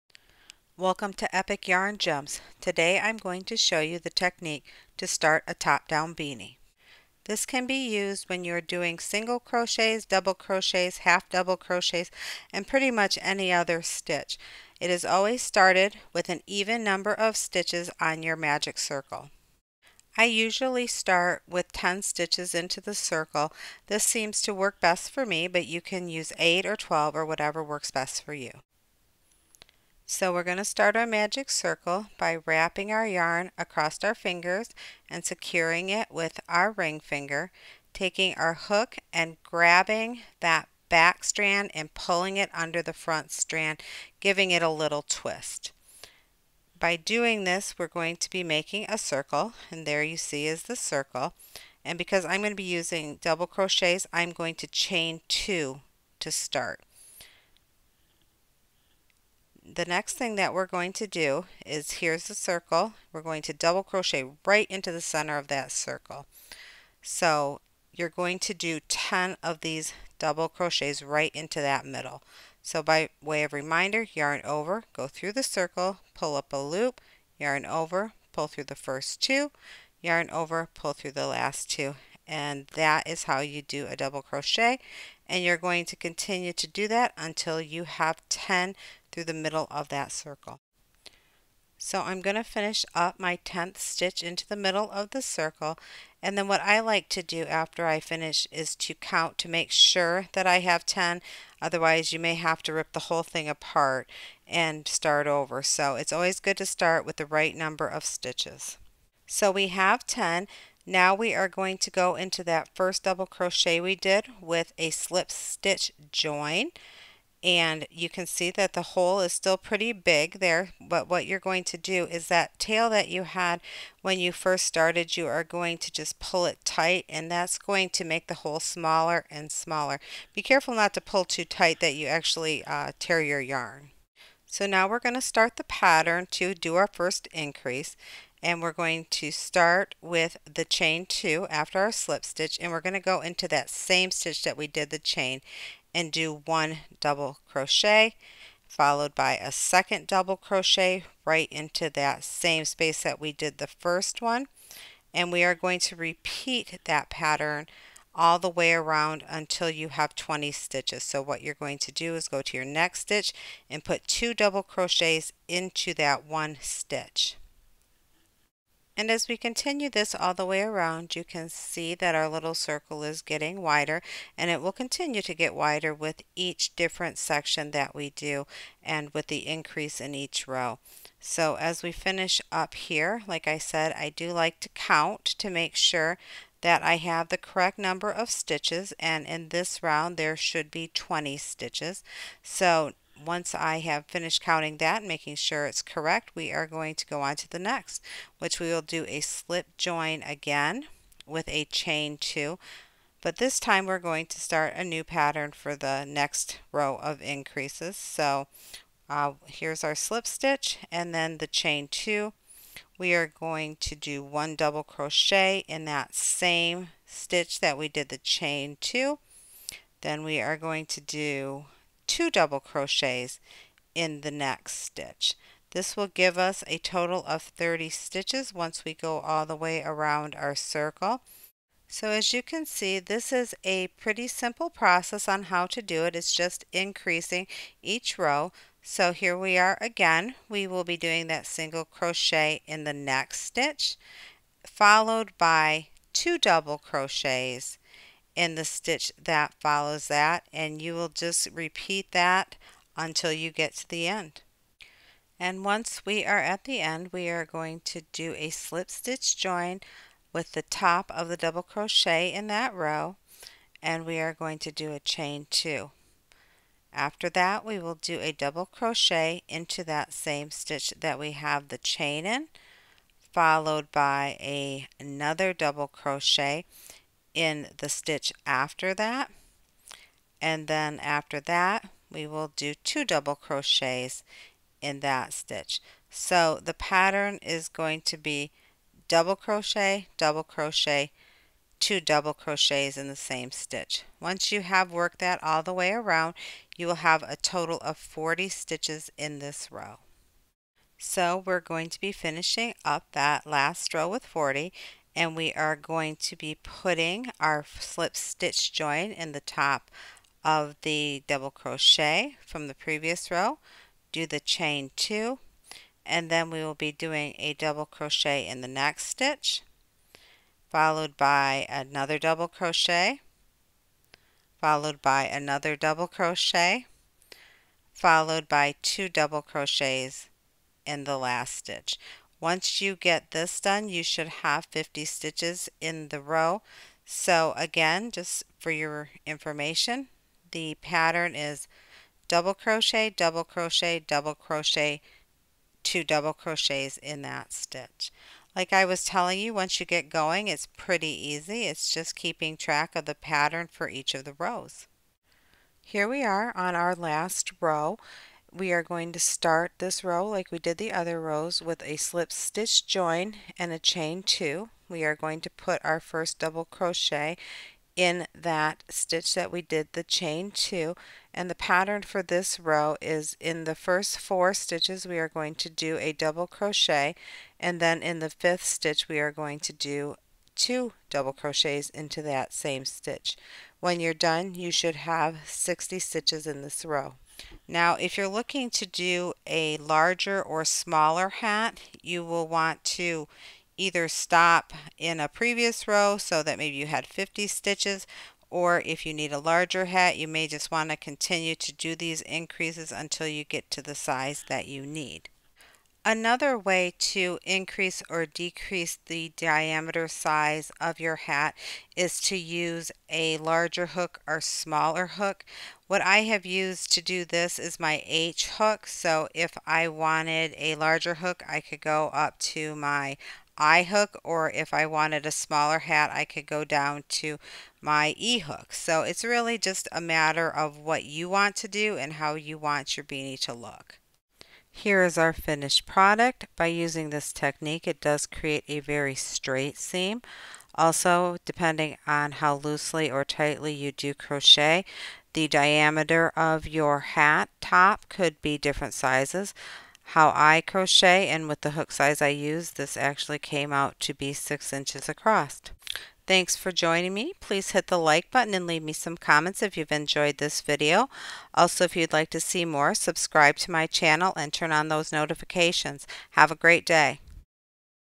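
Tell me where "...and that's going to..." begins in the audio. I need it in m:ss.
2:07.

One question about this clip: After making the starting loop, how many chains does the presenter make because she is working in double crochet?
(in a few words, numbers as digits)
2.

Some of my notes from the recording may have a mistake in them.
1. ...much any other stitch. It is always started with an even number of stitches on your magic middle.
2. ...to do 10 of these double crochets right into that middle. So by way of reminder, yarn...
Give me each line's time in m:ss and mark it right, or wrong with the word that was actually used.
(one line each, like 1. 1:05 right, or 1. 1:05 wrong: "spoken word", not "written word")
1. 0:12 wrong: "circle", not "middle"
2. 1:08 right.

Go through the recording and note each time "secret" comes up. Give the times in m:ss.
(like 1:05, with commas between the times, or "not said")
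not said.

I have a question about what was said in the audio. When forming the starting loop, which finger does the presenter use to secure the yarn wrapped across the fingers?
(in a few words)
ring finger.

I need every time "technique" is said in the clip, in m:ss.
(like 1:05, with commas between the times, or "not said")
0:04, 7:17.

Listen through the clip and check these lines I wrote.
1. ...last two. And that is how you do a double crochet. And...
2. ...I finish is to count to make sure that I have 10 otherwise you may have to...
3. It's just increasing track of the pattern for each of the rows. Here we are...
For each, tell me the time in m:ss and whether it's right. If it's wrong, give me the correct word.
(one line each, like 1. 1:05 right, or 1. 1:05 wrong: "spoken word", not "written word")
1. 1:21 right
2. 1:37 right
3. 5:51 wrong: "keeping", not "increasing".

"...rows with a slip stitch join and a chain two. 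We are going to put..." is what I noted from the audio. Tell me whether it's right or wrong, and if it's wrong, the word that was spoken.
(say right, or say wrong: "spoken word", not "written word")
right.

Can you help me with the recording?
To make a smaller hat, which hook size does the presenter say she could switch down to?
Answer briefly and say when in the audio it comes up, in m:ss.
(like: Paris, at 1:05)
E hook, at 7:08.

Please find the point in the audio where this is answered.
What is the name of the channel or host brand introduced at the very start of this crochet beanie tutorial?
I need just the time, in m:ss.
0:01.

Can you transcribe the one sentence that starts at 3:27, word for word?
So uh, here's our slip stitch and then the chain 2.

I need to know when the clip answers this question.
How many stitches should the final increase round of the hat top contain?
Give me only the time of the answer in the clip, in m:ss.
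6:25.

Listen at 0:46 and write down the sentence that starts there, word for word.
By doing this, we're going to be making a circle, and there you see is the circle.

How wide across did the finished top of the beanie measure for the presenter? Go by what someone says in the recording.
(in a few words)
6 inches.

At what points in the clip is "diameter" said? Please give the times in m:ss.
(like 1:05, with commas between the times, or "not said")
6:49, 7:25.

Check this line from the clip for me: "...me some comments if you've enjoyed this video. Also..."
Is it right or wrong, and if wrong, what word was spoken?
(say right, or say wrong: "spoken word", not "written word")
right.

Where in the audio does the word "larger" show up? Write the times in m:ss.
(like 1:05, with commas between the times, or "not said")
6:29, 6:39, 6:53, 7:00.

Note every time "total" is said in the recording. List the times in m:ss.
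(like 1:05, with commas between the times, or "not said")
3:46, 4:57.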